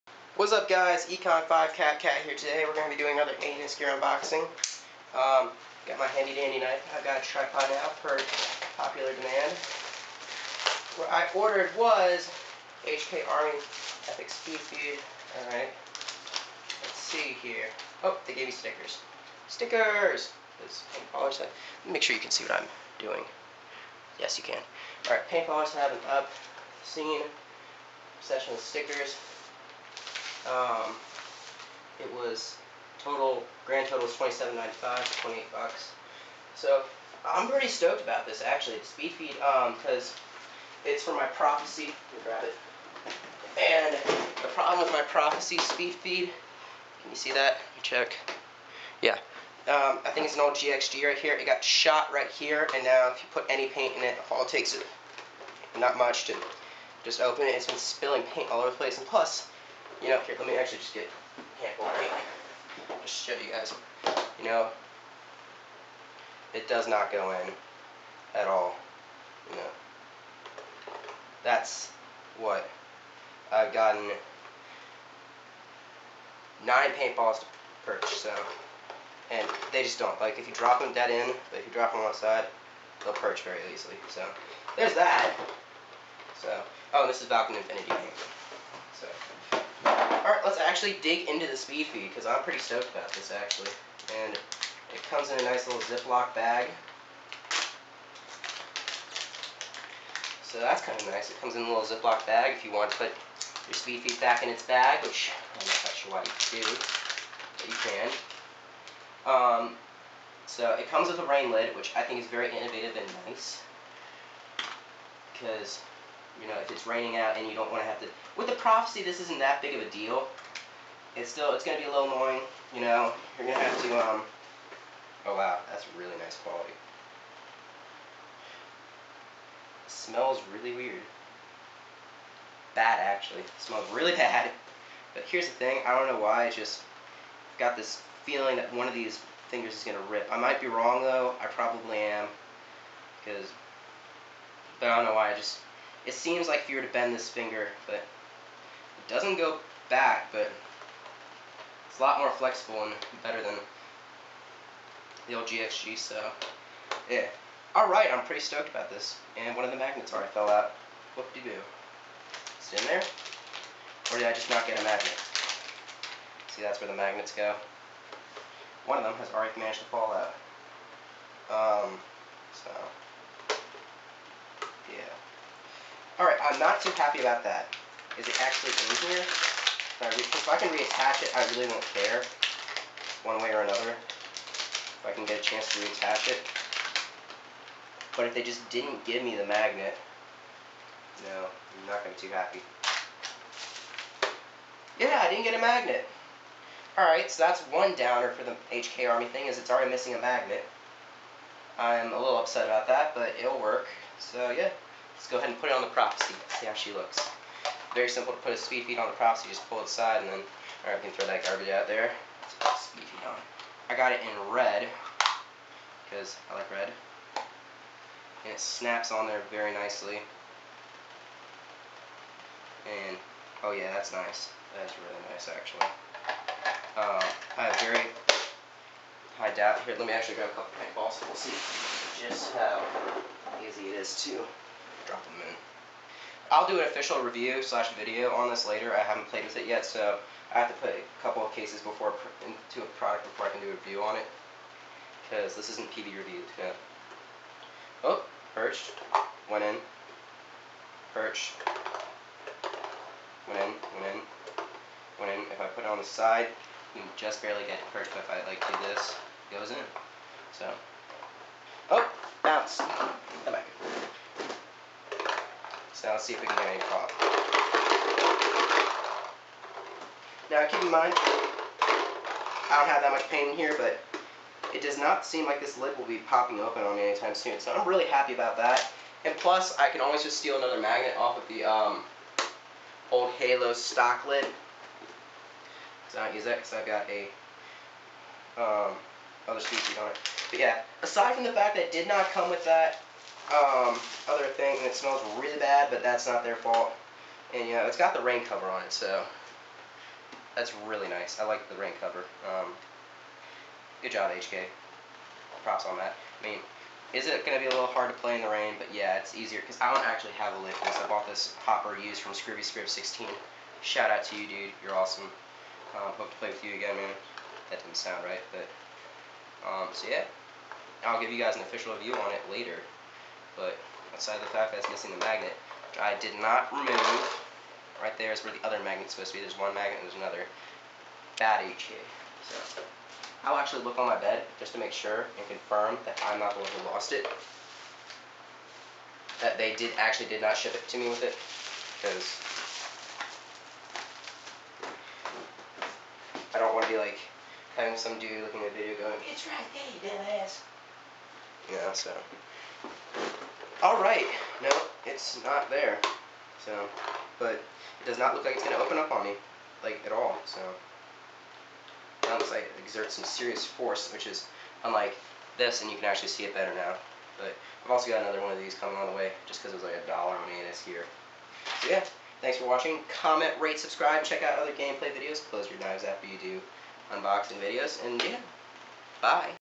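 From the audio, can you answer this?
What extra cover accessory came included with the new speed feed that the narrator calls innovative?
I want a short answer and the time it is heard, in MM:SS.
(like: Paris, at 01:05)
rain lid, at 01:51.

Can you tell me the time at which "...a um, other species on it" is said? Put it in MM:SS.
04:47.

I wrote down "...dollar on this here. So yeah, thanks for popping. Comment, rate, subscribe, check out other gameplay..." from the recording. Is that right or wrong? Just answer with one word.
wrong.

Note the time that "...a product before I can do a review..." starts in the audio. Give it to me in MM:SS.
04:02.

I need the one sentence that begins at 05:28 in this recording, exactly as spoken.
Right there is where the other magnet's supposed to be.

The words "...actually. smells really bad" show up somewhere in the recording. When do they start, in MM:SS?
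02:12.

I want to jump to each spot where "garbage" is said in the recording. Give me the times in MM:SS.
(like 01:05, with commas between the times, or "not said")
03:31.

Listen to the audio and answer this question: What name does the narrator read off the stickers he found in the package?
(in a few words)
Falcon Infinity.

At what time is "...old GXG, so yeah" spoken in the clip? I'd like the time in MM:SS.
02:35.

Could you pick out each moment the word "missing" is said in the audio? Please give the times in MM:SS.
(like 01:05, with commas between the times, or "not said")
03:19, 05:24.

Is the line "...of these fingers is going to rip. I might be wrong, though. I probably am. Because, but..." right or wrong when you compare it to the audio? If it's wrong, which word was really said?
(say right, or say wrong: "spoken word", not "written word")
right.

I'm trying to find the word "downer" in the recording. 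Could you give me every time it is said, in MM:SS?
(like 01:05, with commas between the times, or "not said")
03:17.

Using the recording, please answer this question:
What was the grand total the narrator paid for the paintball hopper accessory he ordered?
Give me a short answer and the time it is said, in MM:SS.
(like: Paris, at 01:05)
$27.95, at 00:34.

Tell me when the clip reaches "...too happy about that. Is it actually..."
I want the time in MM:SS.
02:56.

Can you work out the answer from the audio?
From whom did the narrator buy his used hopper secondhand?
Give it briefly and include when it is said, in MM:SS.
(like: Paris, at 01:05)
Scribby Scrib 16, at 05:12.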